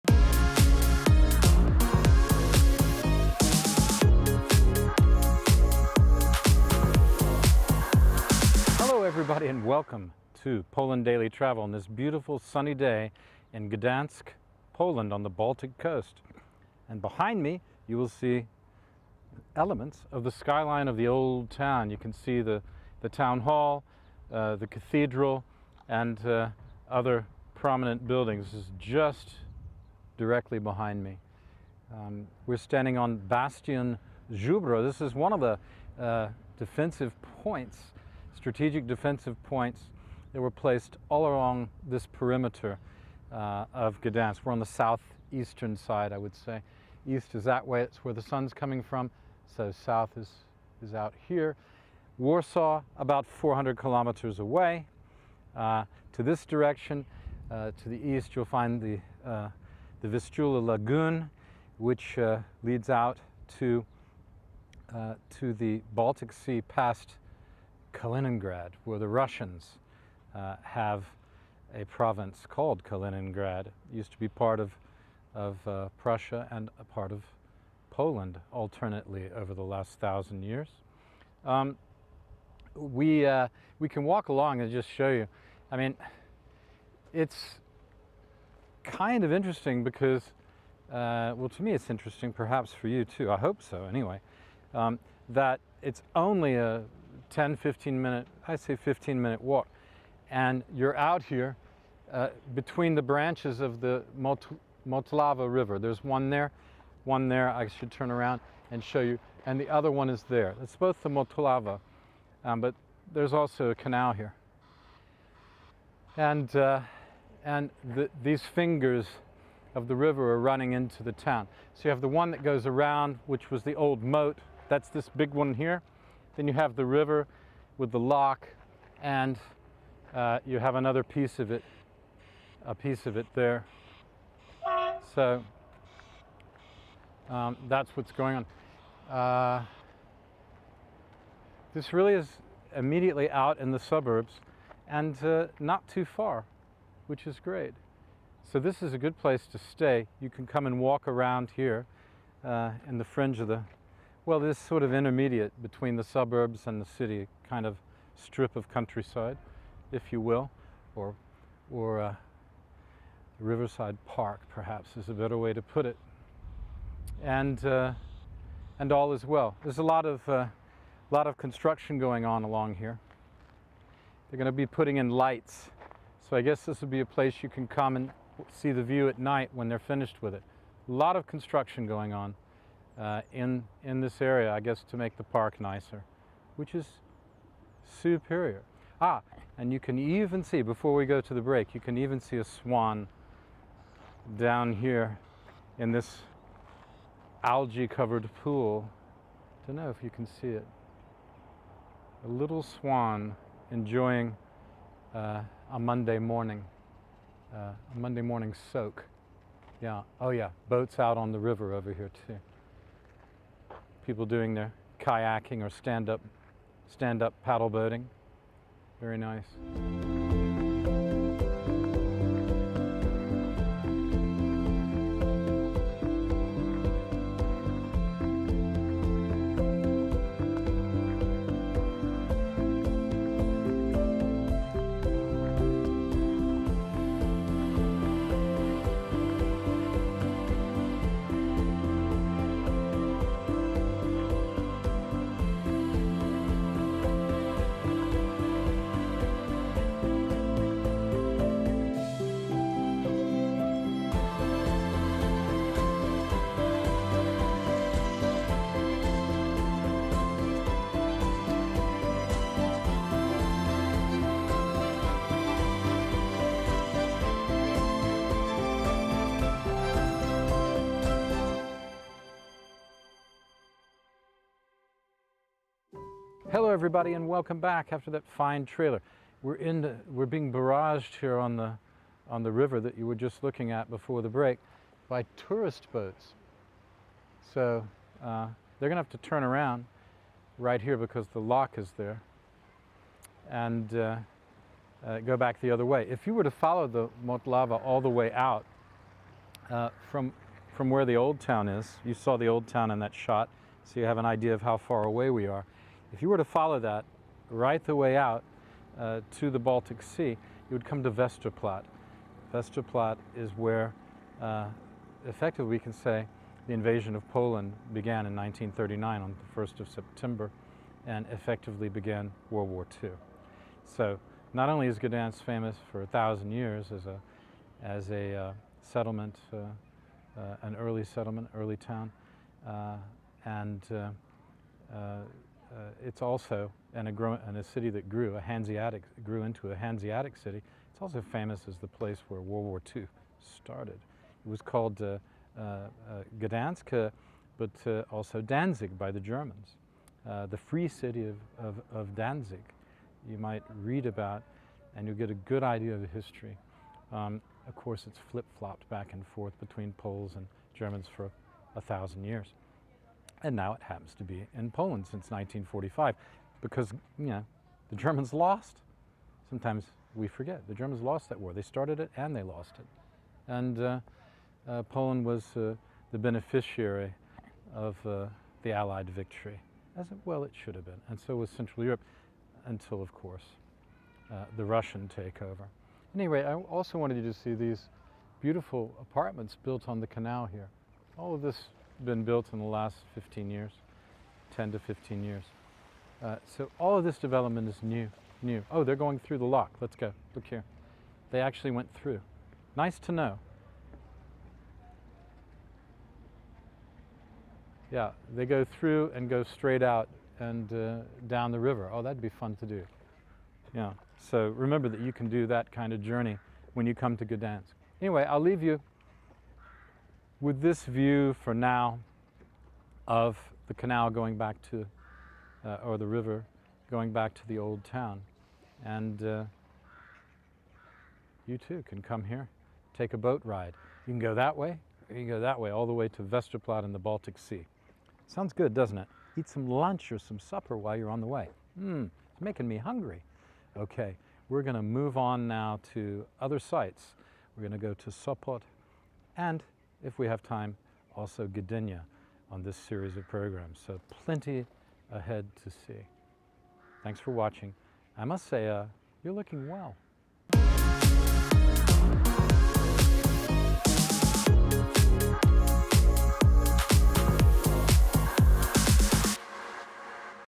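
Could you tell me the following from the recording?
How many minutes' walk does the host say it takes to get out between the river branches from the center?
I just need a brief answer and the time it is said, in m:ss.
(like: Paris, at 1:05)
15 minutes, at 1:38.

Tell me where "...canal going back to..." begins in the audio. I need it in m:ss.
7:03.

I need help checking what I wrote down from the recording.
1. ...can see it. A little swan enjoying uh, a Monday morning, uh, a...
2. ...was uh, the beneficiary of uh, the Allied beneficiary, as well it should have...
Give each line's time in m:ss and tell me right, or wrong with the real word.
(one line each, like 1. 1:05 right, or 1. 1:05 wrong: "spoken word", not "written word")
1. 3:20 right
2. 6:15 wrong: "victory", not "beneficiary".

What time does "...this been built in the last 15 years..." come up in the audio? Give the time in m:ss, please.
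6:31.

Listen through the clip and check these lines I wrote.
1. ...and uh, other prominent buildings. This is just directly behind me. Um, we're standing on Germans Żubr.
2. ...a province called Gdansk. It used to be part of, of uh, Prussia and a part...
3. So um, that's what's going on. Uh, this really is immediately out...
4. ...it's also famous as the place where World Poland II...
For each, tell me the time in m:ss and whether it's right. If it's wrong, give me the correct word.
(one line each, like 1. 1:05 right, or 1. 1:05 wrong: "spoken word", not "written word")
1. 0:25 wrong: "Bastion", not "Germans"
2. 1:11 wrong: "Kaliningrad", not "Gdansk"
3. 2:15 right
4. 5:40 wrong: "War", not "Poland".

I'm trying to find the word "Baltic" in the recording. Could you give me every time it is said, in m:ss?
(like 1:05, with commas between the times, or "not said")
0:15, 1:05, 5:09, 7:16.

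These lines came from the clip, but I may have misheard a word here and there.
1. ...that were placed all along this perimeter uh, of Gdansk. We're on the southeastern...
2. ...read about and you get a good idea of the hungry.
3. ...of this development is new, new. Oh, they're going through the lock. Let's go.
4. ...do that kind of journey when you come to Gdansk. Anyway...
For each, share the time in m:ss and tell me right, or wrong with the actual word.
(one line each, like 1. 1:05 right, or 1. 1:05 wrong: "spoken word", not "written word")
1. 0:40 right
2. 5:53 wrong: "history", not "hungry"
3. 6:36 right
4. 6:55 right.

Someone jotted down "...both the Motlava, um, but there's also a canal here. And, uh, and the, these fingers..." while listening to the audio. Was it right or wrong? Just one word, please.
right.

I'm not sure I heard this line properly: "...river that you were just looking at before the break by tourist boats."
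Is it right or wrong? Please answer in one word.
right.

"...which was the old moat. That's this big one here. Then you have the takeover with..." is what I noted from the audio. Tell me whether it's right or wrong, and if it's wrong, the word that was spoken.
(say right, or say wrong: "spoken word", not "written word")
wrong: "river", not "takeover".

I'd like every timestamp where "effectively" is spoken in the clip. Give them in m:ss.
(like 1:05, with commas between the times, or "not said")
5:15, 5:21.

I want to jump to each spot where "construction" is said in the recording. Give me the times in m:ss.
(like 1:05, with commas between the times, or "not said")
2:51, 3:01.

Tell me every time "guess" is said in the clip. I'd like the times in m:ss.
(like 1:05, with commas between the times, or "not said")
2:56, 3:04.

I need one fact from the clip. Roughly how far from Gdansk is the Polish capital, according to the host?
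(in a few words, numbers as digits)
400 kilometers.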